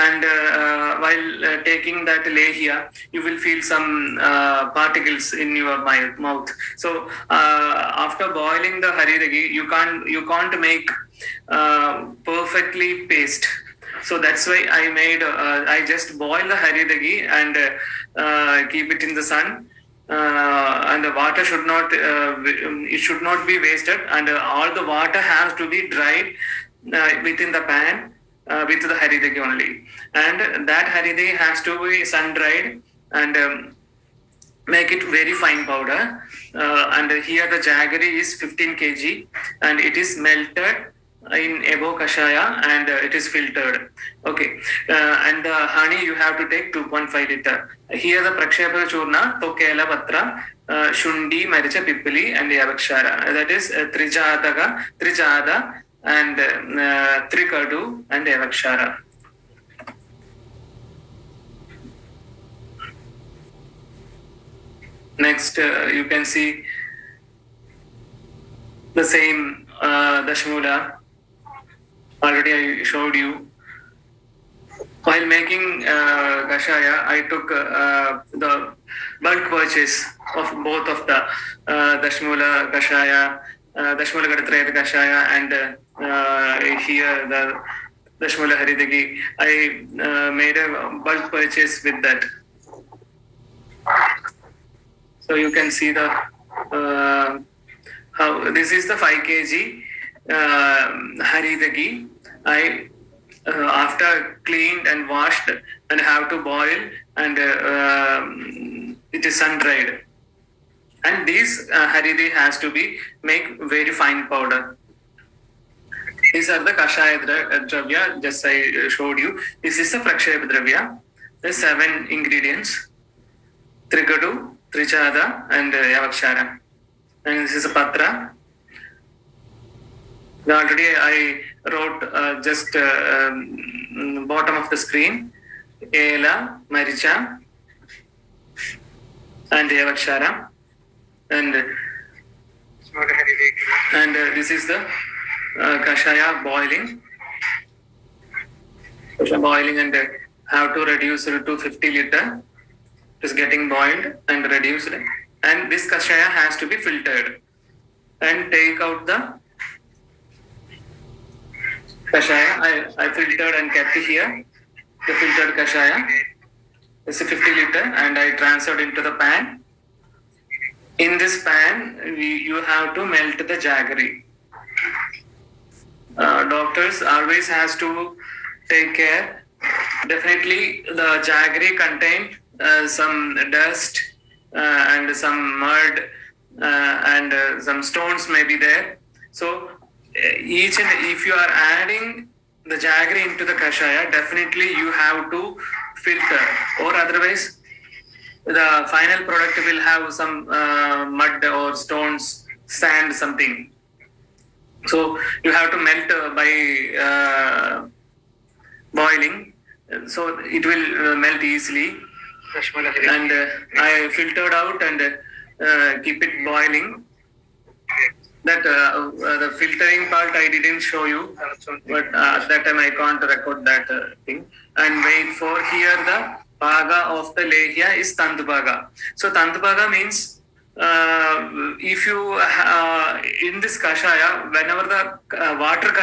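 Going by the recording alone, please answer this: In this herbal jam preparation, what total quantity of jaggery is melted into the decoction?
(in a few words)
15 kg.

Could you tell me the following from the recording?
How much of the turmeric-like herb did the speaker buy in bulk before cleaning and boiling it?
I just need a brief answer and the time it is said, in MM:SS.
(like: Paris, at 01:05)
5 kg, at 01:38.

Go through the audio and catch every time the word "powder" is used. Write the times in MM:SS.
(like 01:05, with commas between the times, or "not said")
00:35, 01:54.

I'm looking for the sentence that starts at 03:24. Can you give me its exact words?
So you have to melt uh, by uh, boiling, so it will uh, melt easily.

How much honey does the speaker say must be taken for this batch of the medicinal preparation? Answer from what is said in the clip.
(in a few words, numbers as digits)
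2.5 liters.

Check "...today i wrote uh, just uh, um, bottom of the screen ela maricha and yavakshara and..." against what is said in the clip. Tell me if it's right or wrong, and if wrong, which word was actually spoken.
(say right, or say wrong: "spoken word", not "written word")
right.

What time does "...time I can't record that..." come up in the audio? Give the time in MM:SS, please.
03:42.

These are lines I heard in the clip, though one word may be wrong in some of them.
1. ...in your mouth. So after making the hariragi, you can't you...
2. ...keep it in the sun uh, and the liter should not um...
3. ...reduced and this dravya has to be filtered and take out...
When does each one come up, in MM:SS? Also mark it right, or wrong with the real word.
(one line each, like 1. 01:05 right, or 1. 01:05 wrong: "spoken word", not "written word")
1. 00:05 wrong: "boiling", not "making"
2. 00:18 wrong: "water", not "liter"
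3. 02:34 wrong: "kashaya", not "dravya".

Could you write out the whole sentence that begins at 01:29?
I made a bulk purchase with that.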